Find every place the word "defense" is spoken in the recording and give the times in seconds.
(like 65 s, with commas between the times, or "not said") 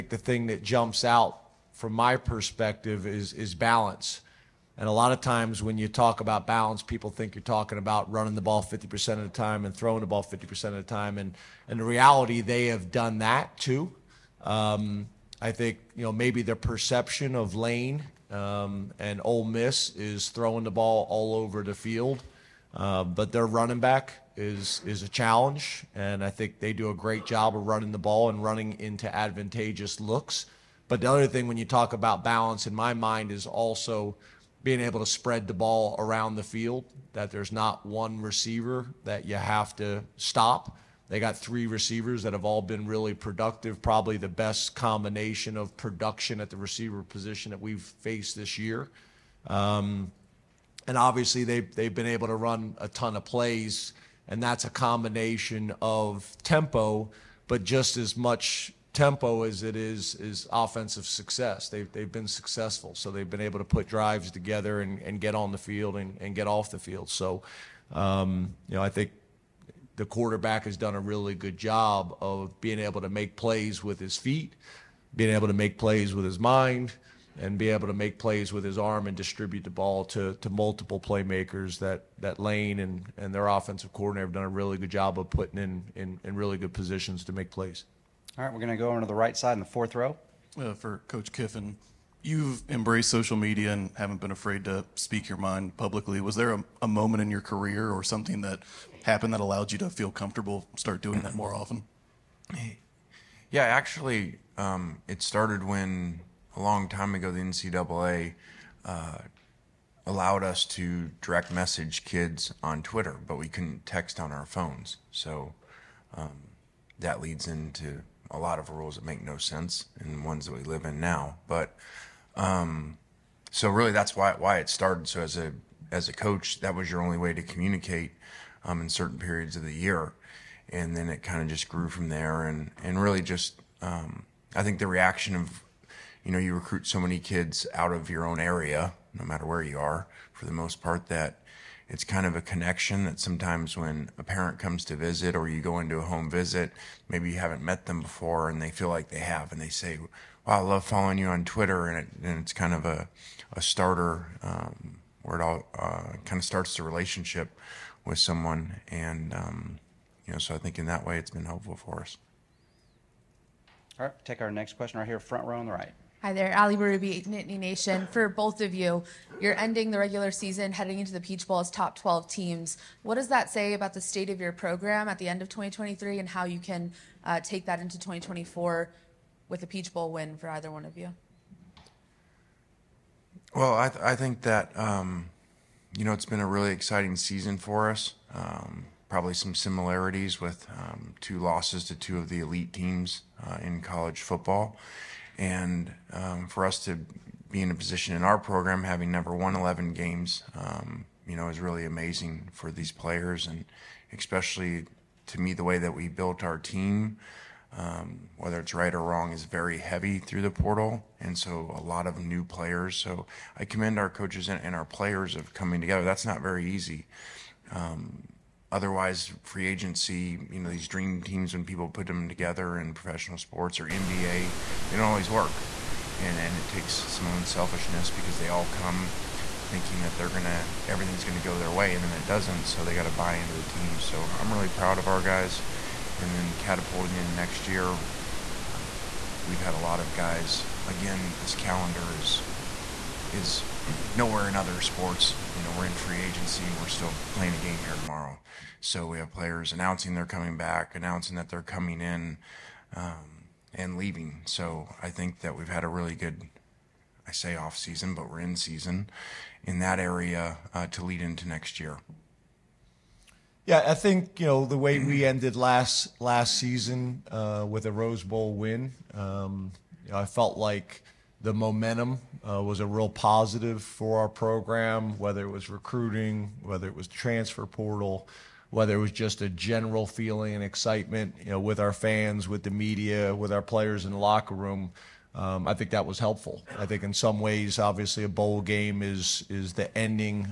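not said.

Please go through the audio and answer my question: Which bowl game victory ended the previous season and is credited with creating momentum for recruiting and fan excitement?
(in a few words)
Rose Bowl.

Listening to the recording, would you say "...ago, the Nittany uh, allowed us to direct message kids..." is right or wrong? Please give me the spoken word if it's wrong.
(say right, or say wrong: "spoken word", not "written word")
wrong: "NCAA", not "Nittany".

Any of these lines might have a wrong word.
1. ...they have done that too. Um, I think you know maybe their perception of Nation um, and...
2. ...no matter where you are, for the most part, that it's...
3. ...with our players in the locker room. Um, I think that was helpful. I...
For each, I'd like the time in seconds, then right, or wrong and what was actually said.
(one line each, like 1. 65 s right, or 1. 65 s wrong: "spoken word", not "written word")
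1. 12 s wrong: "Lane", not "Nation"
2. 139 s right
3. 283 s right.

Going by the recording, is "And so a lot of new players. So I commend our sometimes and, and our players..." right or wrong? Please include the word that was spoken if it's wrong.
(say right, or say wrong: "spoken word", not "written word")
wrong: "coaches", not "sometimes".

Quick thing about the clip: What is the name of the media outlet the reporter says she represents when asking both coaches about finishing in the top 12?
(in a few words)
Nittany Nation.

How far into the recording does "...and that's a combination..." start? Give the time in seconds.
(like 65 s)
54 s.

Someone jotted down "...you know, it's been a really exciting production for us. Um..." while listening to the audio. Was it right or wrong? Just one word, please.
wrong.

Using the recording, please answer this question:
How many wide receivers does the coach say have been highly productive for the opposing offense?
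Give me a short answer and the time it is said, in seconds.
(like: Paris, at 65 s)
3, at 41 s.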